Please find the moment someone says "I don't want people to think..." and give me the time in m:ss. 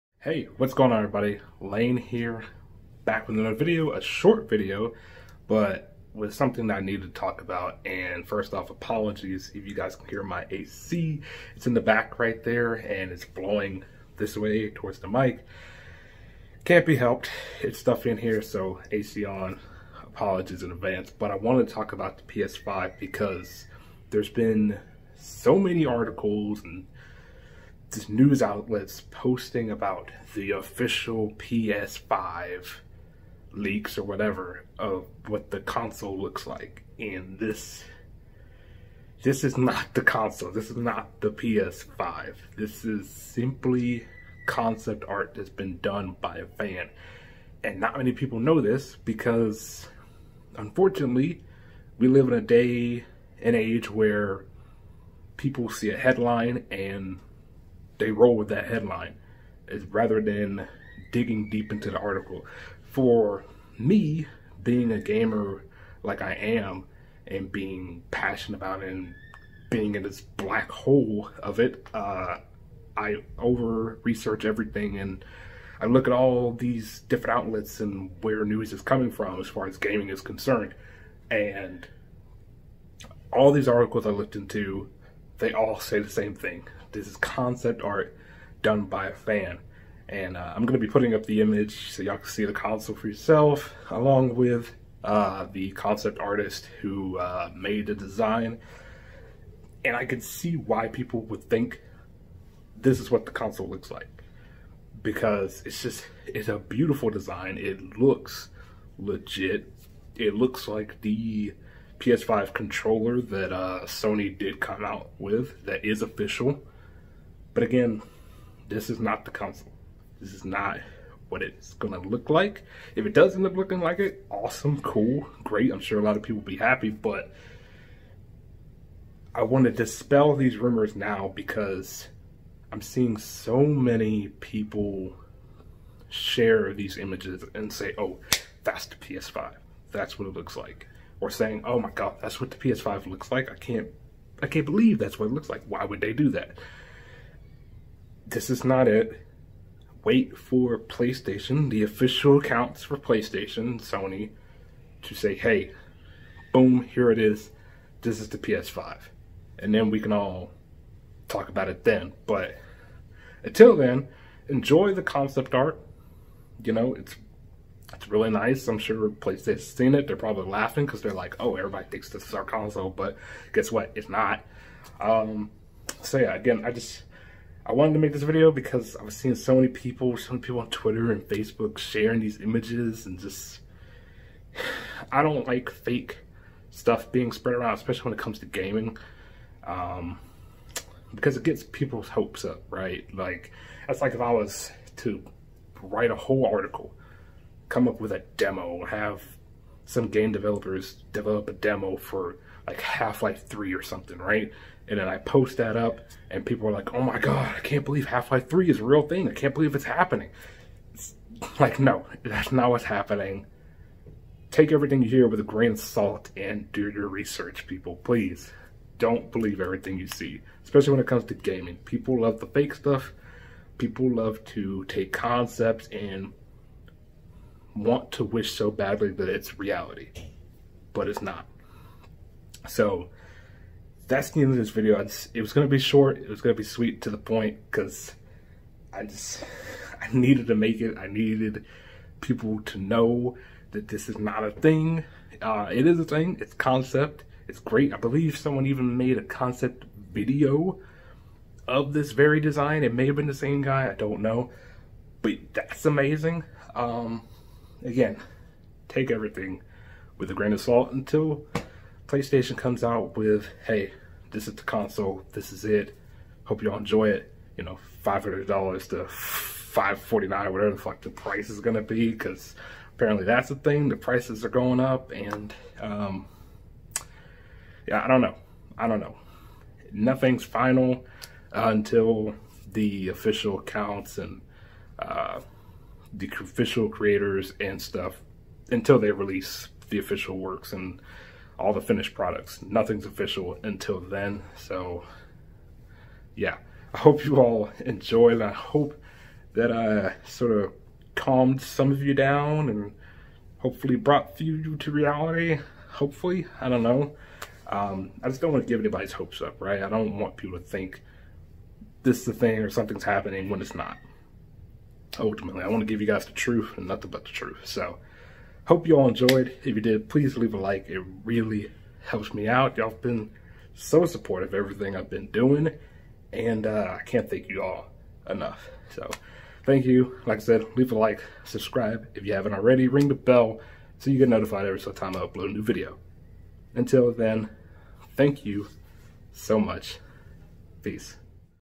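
5:09.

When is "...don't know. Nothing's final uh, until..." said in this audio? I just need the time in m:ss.
4:38.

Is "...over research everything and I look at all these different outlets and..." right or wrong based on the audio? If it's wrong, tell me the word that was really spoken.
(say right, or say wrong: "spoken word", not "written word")
right.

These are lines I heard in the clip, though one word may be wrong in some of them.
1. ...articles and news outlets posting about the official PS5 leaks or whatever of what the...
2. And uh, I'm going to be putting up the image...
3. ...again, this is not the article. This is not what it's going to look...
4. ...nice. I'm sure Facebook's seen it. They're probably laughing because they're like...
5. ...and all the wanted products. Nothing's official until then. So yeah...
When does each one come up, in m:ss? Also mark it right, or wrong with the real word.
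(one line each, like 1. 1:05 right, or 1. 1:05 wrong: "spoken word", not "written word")
1. 0:25 right
2. 1:30 right
3. 1:57 wrong: "console", not "article"
4. 2:48 wrong: "PlayStation", not "Facebook"
5. 4:50 wrong: "finished", not "wanted".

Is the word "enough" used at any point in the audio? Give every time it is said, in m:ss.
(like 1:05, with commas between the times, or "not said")
5:28.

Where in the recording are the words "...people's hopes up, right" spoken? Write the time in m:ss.
3:11.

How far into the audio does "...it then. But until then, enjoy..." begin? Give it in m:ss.
2:41.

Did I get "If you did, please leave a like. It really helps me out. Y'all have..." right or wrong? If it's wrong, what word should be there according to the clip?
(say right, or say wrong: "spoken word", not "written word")
right.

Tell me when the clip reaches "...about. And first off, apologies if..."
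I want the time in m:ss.
0:07.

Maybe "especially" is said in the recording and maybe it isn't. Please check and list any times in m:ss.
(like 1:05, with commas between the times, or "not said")
3:07, 3:40.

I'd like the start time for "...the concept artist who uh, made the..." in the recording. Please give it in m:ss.
1:35.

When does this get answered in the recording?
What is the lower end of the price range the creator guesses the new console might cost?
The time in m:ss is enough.
4:28.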